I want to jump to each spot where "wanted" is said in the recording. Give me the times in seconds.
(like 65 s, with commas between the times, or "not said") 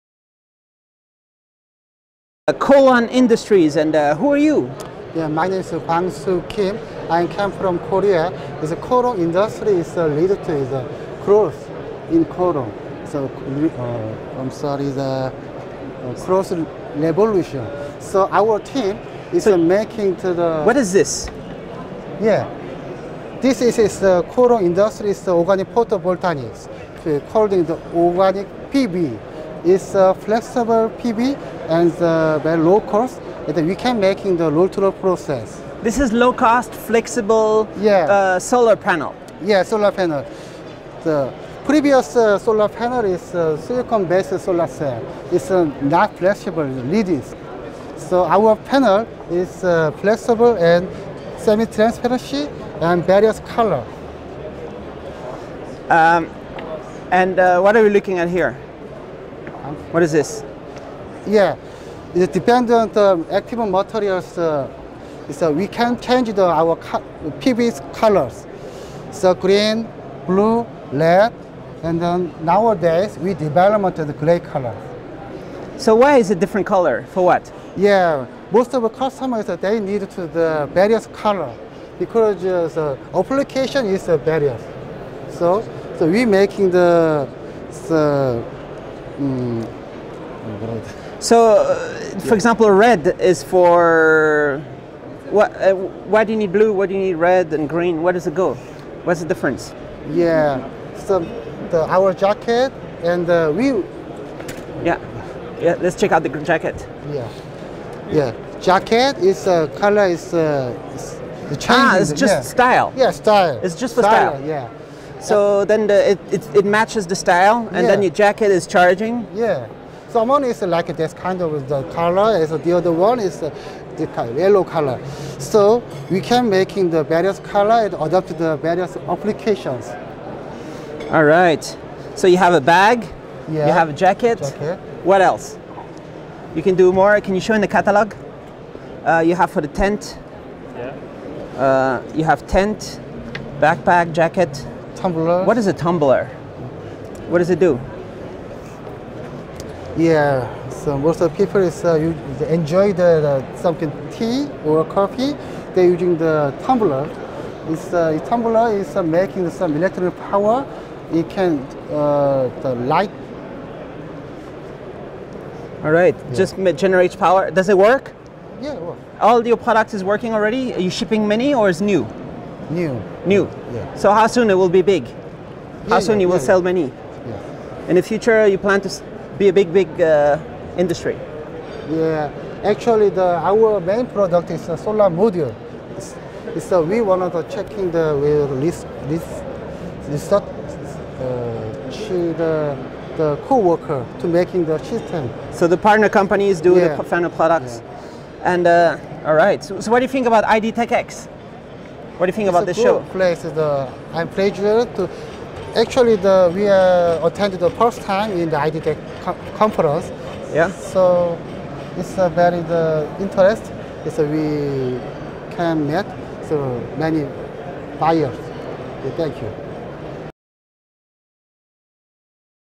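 187 s.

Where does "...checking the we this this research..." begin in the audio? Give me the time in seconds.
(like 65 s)
187 s.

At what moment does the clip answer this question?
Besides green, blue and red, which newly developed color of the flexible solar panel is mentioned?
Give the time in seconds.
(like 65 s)
74 s.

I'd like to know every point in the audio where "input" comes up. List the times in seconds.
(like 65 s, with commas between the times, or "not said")
not said.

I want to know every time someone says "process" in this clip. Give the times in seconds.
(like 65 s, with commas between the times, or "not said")
35 s.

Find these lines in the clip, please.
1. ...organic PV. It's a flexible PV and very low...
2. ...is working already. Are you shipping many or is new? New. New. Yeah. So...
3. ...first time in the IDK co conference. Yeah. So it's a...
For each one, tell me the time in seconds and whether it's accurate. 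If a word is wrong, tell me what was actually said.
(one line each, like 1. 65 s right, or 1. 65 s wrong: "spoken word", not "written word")
1. 27 s right
2. 169 s right
3. 207 s right.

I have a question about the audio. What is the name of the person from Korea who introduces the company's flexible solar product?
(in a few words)
Bang Soo Kim.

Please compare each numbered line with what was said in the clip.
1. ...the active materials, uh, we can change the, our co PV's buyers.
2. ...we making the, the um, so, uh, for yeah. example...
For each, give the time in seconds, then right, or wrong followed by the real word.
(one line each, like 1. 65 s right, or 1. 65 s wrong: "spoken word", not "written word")
1. 62 s wrong: "colors", not "buyers"
2. 86 s right.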